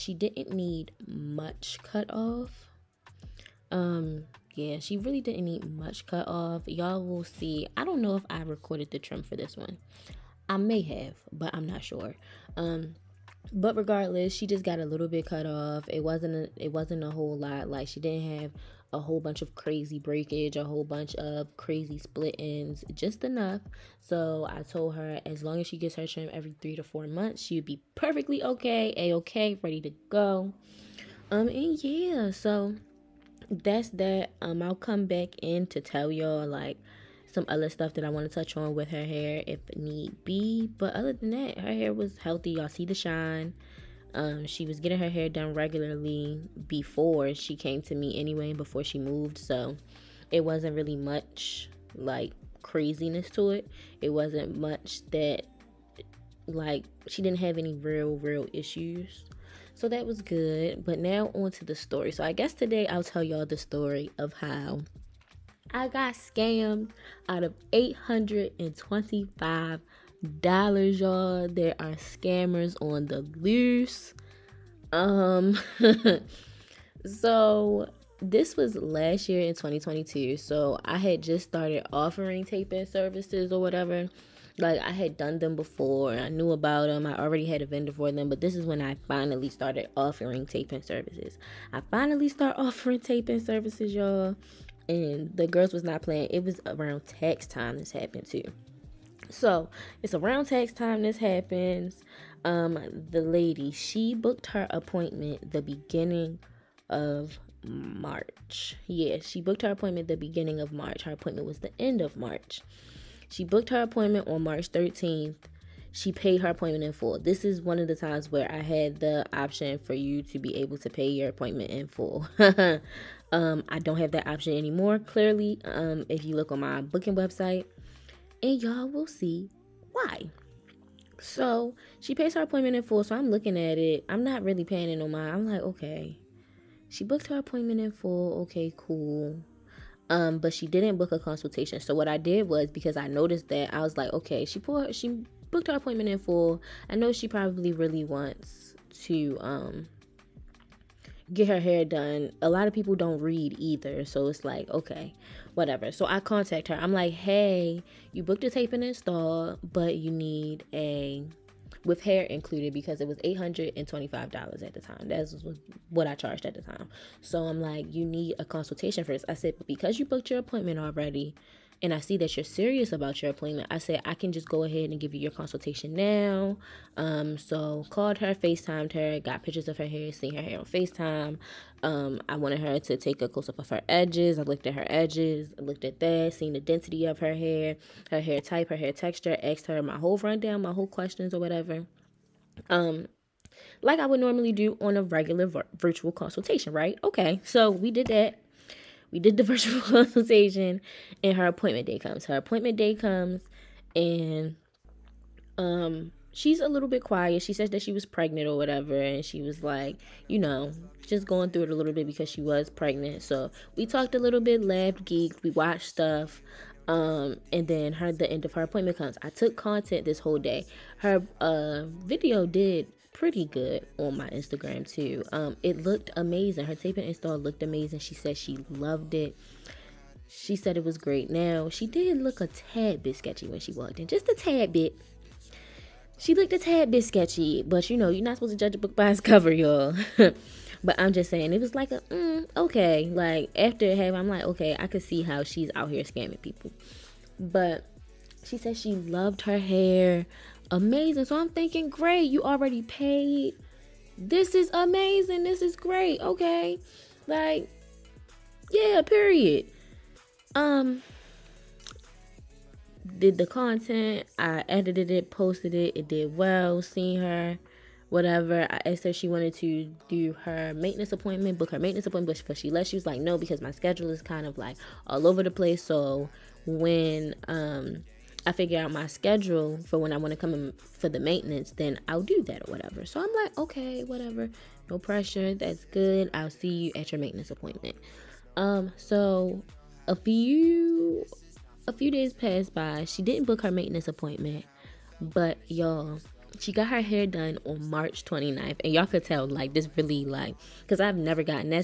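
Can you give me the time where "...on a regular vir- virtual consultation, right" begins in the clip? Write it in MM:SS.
03:14.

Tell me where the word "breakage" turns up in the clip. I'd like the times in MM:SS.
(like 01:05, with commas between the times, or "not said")
00:19.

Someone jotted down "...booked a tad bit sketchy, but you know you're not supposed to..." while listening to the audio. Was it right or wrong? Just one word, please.
wrong.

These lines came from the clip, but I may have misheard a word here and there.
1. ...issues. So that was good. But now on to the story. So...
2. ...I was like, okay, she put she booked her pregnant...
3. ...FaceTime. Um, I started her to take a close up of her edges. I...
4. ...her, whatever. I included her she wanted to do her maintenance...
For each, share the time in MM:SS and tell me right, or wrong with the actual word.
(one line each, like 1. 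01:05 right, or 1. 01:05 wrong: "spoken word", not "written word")
1. 00:58 right
2. 02:23 wrong: "appointment", not "pregnant"
3. 03:00 wrong: "wanted", not "started"
4. 04:27 wrong: "asked", not "included".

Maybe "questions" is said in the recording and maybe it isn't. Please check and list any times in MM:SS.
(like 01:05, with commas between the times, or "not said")
03:10.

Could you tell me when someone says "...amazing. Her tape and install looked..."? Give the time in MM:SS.
03:46.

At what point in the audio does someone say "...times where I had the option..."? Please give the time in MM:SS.
01:57.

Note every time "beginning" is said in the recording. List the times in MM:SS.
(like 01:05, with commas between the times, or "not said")
01:45, 01:50.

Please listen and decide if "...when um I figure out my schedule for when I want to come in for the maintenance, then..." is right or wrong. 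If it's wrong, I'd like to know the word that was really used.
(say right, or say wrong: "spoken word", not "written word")
right.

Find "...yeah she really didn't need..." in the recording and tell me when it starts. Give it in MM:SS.
00:04.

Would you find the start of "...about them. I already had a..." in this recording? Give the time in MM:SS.
01:26.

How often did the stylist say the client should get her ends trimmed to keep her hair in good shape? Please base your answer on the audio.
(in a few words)
every 3 to 4 months.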